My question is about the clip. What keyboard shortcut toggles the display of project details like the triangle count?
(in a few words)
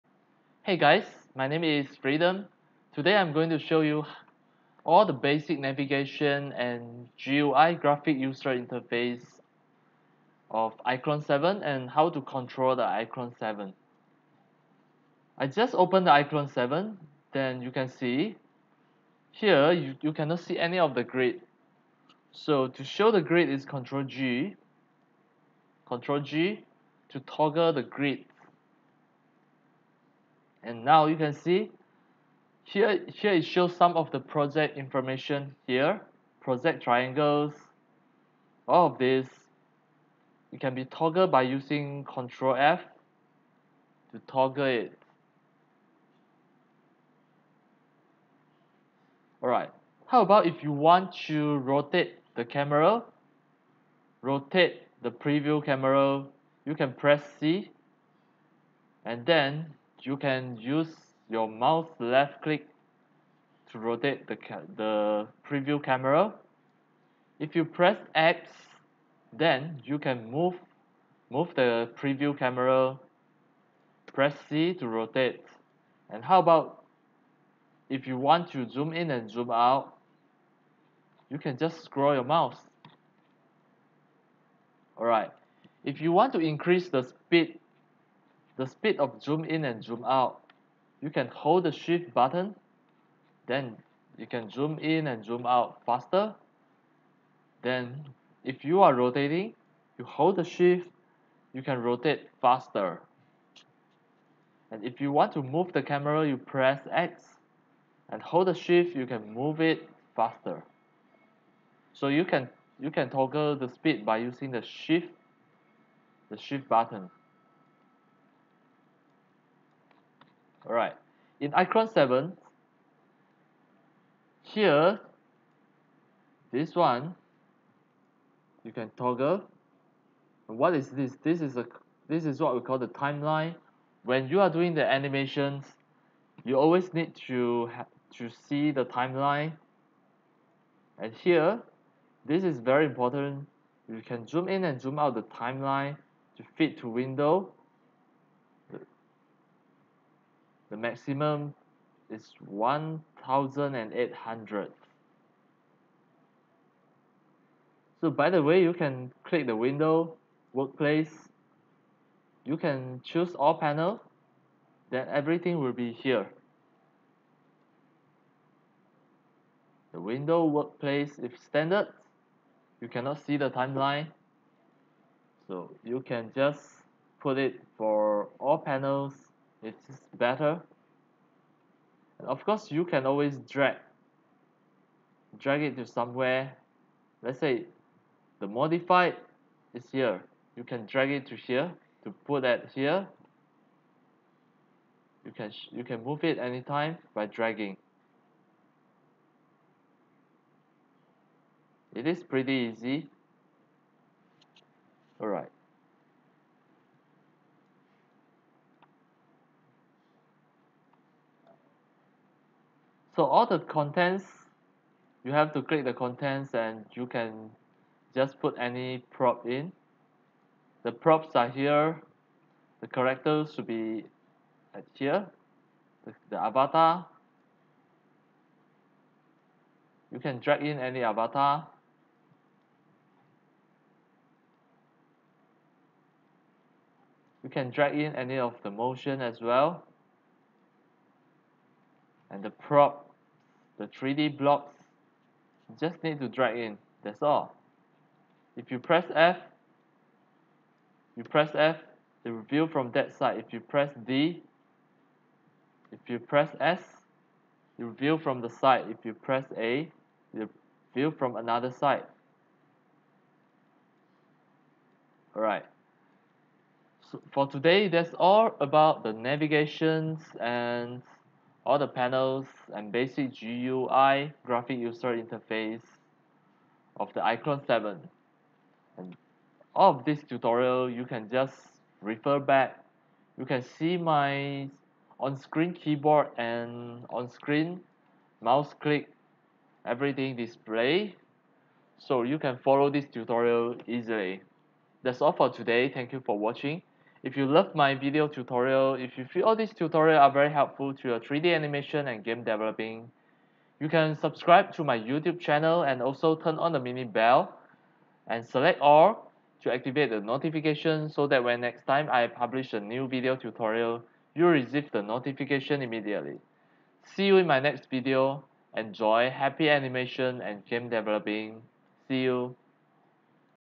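Control F.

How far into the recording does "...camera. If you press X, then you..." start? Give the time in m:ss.
1:05.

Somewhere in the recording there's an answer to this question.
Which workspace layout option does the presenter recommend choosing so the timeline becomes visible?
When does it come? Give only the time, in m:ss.
2:58.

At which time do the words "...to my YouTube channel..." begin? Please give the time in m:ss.
5:04.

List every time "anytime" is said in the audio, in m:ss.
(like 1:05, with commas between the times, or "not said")
3:16.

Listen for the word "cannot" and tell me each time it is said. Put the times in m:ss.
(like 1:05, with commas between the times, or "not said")
0:20, 2:52.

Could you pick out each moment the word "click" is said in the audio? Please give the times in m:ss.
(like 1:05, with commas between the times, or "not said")
1:02, 2:39, 3:35, 4:48.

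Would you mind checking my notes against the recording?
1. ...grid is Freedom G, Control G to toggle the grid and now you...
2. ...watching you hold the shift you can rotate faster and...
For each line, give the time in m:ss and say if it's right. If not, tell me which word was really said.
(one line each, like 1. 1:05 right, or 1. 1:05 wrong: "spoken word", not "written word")
1. 0:23 wrong: "Control", not "Freedom"
2. 1:38 wrong: "rotating", not "watching".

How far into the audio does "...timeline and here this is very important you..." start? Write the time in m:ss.
2:18.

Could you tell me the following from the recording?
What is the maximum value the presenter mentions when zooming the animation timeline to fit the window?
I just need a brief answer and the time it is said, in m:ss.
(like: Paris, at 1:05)
1800, at 2:32.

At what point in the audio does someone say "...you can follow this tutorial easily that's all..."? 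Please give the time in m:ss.
4:52.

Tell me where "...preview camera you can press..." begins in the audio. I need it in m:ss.
0:55.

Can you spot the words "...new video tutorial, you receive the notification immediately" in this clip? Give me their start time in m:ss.
5:12.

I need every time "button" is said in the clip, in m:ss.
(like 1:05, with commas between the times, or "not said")
1:32, 1:56.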